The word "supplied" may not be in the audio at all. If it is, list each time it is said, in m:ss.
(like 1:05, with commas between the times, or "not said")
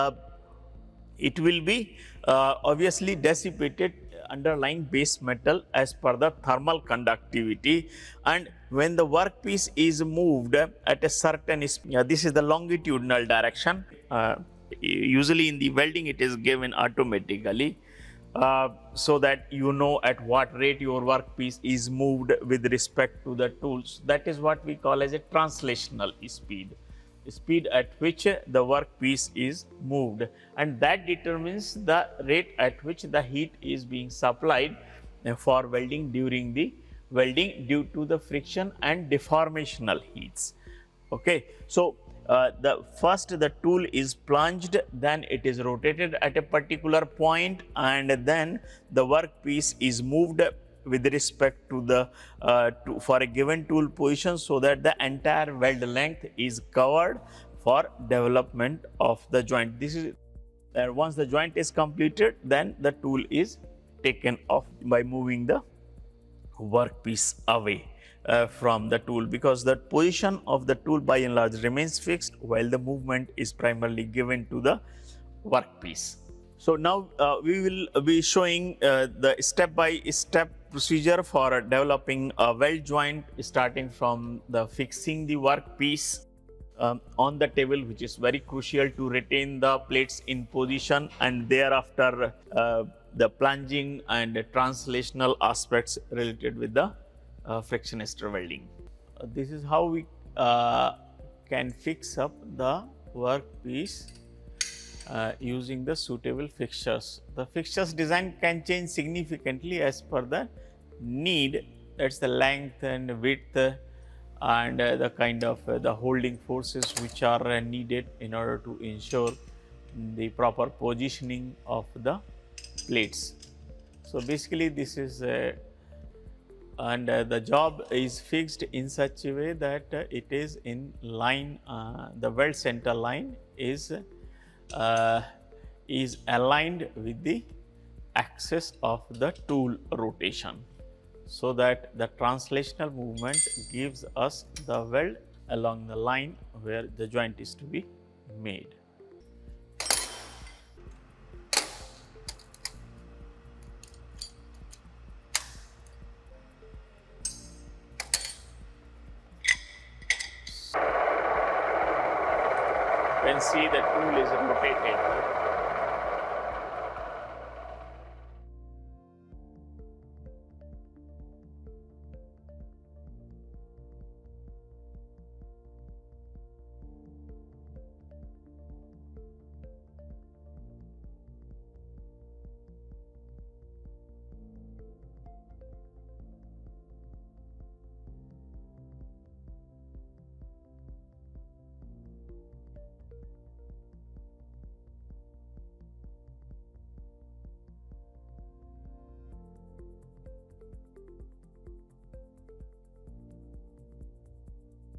0:34.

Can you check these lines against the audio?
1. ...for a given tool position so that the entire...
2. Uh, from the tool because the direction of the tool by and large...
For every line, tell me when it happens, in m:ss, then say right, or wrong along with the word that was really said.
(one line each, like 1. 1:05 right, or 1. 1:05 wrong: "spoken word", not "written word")
1. 0:52 right
2. 1:08 wrong: "position", not "direction".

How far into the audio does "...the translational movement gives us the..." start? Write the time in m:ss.
2:21.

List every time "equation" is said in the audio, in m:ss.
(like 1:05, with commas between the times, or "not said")
not said.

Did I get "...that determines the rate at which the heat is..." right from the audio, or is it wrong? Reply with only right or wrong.
right.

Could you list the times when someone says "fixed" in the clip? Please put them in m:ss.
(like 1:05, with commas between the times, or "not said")
1:11, 2:08.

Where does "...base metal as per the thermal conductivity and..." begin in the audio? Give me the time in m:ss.
0:04.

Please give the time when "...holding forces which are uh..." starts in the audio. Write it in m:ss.
1:55.